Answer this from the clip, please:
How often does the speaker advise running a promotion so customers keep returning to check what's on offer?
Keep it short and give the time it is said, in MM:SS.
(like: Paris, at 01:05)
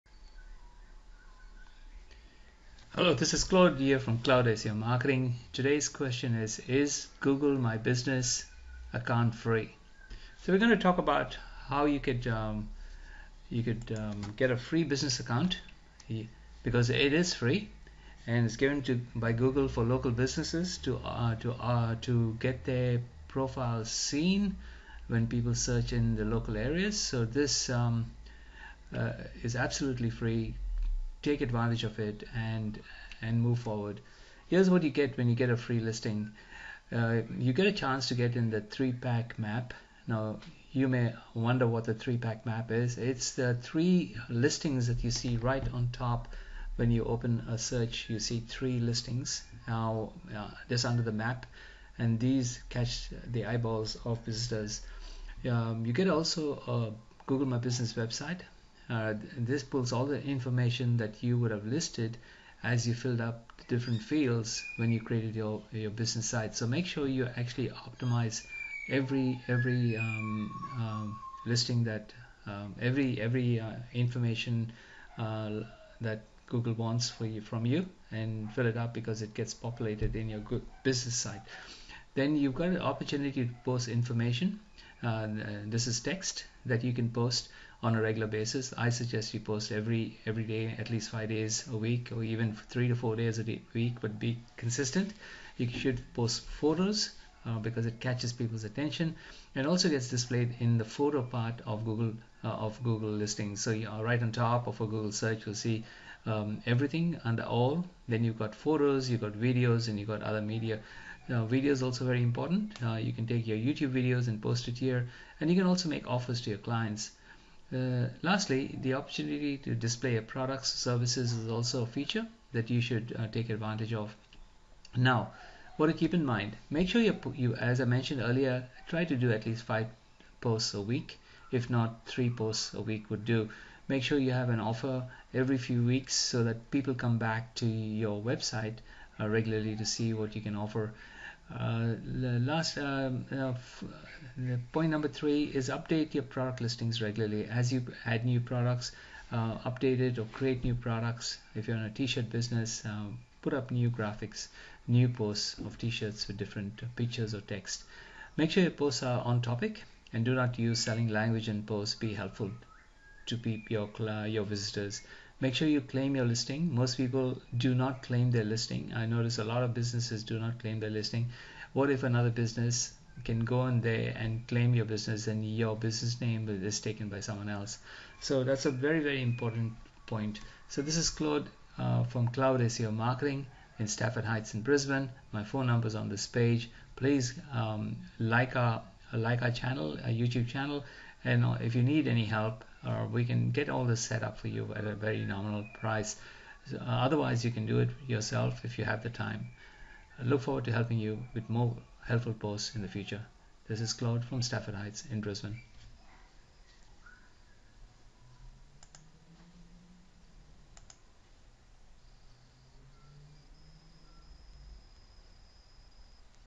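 Every few weeks, at 02:15.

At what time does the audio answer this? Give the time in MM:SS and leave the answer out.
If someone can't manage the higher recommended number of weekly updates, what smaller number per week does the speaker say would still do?
02:12.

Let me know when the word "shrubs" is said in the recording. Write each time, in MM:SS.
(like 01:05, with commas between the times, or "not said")
not said.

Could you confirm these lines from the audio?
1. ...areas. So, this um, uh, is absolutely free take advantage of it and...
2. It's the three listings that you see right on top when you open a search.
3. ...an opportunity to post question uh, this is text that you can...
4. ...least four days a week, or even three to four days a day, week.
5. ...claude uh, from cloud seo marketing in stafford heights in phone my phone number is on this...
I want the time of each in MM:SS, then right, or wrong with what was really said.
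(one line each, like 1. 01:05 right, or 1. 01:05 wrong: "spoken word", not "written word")
1. 00:26 right
2. 00:42 right
3. 01:22 wrong: "information", not "question"
4. 01:30 wrong: "five", not "four"
5. 03:01 wrong: "brisbane", not "phone".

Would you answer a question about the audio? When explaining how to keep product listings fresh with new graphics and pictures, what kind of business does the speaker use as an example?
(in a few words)
T-shirt business.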